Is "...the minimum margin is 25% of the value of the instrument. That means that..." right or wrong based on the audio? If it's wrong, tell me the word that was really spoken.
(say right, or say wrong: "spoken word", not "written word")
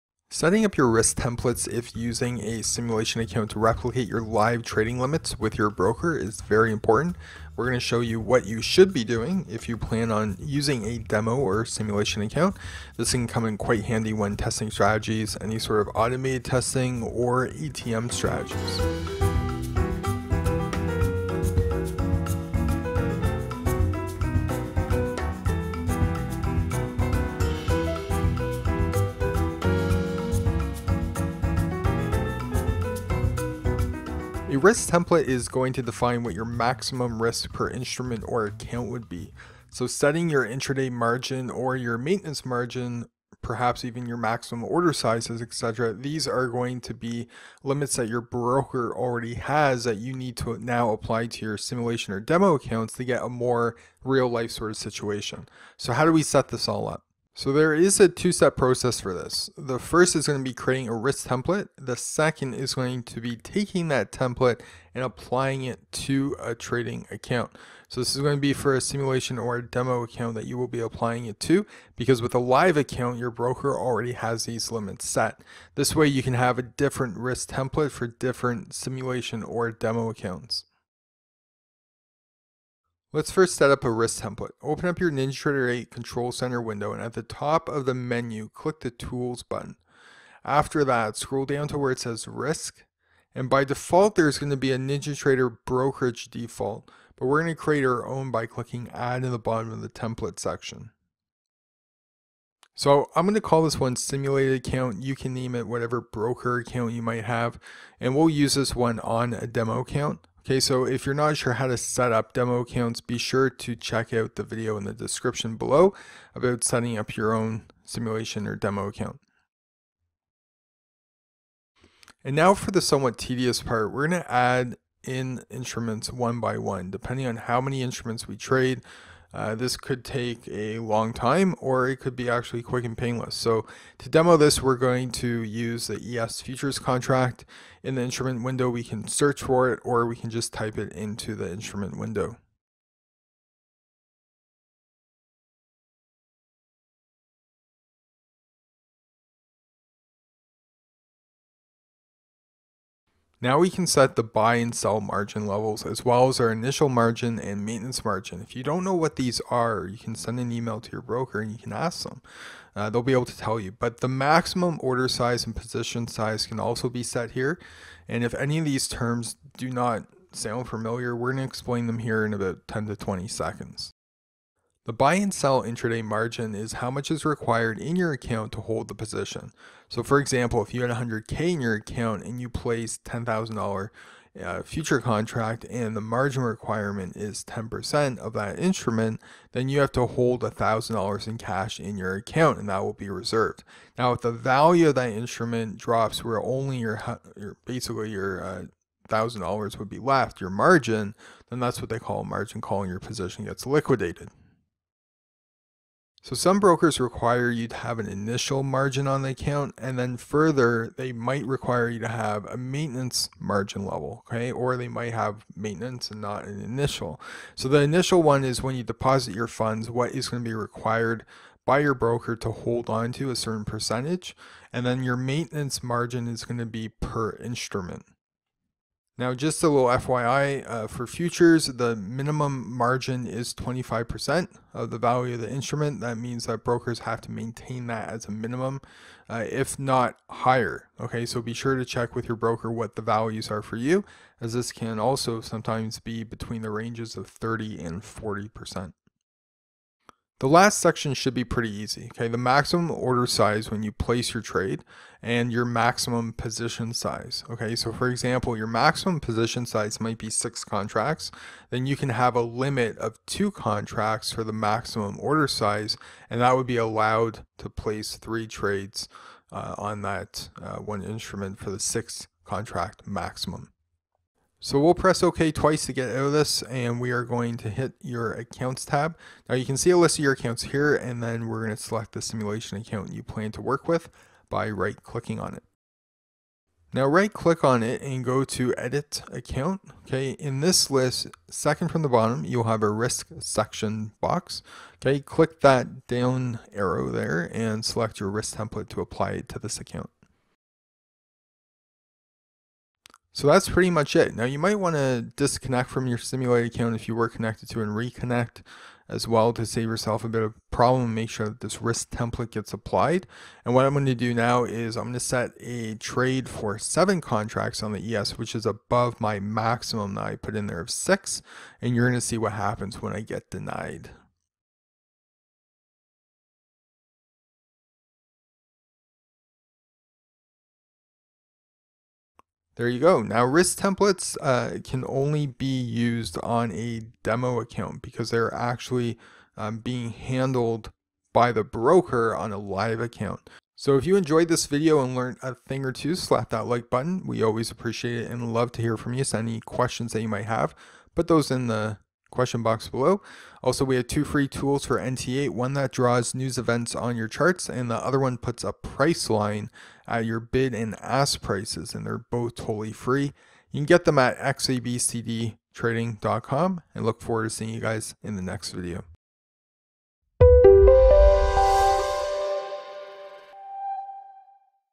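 right.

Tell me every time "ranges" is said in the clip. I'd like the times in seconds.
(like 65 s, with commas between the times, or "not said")
246 s.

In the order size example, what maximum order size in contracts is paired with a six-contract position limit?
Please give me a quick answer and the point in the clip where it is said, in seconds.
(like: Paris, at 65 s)
2 contracts, at 263 s.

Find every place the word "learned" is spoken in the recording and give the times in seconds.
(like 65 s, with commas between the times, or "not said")
345 s.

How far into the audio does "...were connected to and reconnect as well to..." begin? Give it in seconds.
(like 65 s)
307 s.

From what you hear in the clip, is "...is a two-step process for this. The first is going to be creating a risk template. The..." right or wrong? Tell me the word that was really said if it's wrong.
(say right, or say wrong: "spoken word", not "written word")
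right.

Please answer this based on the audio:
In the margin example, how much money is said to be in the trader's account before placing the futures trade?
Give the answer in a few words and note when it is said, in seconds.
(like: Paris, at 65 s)
100K, at 180 s.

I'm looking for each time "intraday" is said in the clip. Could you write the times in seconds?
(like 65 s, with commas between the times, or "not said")
40 s, 175 s.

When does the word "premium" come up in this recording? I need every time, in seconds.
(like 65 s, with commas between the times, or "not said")
not said.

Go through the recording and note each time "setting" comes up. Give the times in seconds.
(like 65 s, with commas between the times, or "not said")
0 s, 39 s, 116 s.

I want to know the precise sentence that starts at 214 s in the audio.
Or they might have maintenance and not an initial.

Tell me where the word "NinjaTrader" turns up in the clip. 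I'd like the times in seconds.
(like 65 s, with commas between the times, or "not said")
85 s, 94 s.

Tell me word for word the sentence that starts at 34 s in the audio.
risk template is going to define what your maximum risk per instrument or account would be.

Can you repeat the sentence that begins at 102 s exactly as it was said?
So I'm going to call this one simulated account.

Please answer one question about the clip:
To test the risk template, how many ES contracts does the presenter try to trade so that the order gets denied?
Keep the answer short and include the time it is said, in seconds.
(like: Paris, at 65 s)
7, at 316 s.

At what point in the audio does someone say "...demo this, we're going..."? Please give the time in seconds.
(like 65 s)
134 s.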